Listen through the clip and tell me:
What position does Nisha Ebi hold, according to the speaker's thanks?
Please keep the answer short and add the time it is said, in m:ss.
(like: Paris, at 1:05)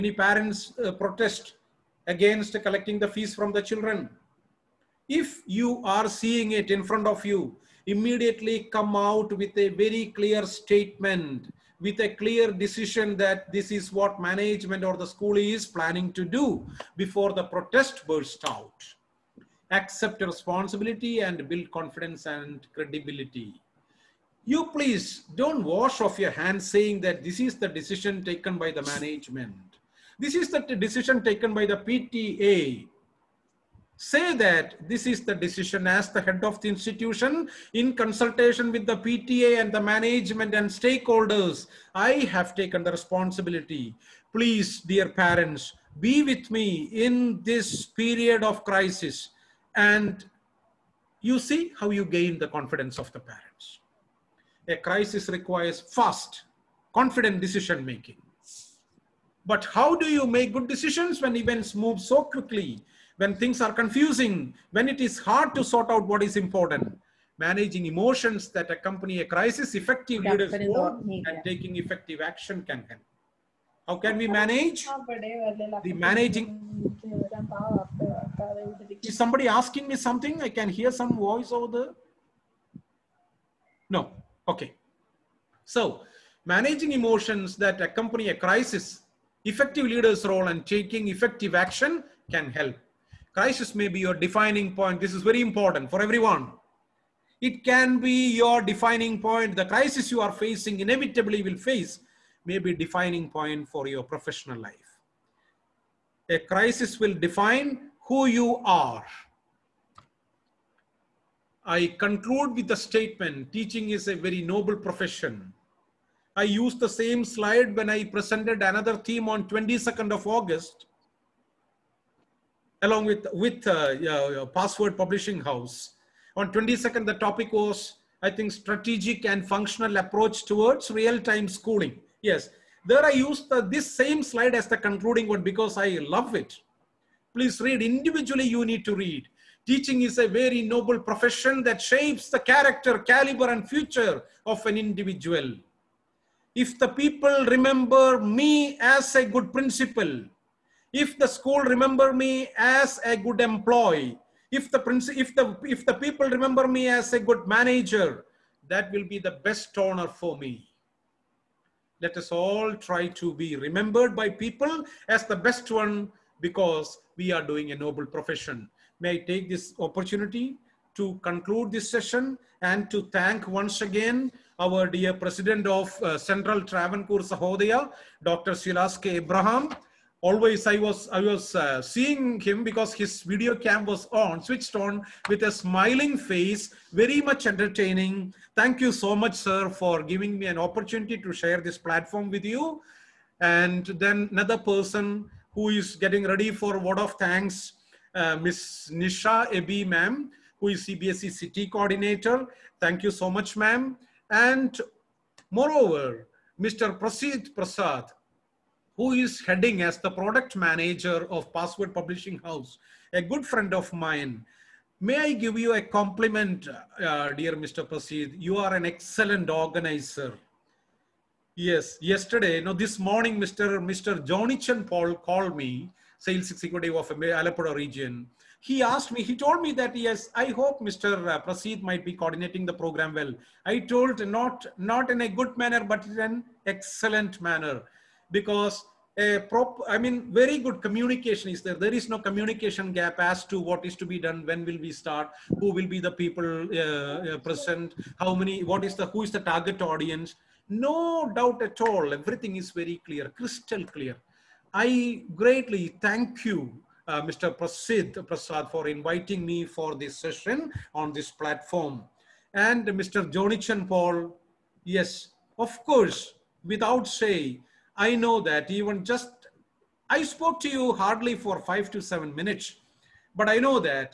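CBSE City Coordinator, at 3:20.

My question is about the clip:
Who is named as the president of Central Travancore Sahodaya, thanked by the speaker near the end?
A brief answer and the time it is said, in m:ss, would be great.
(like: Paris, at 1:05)
Dr. Silas K. Abraham, at 2:58.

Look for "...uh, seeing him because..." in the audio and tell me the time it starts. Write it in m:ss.
3:01.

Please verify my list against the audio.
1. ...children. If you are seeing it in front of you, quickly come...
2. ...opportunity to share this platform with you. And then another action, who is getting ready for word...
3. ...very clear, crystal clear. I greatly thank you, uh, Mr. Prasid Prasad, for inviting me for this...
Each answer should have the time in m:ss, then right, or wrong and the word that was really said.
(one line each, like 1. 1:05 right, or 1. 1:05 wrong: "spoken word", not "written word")
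1. 0:03 wrong: "immediately", not "quickly"
2. 3:10 wrong: "person", not "action"
3. 4:12 right.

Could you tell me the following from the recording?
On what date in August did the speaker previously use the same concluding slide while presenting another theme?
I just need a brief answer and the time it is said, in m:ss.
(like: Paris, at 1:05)
22nd of August, at 1:59.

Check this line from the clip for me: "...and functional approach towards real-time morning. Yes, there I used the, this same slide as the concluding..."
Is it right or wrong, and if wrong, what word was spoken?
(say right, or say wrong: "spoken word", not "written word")
wrong: "schooling", not "morning".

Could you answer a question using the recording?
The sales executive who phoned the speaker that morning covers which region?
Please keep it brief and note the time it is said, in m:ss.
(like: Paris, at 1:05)
Alapura, at 3:47.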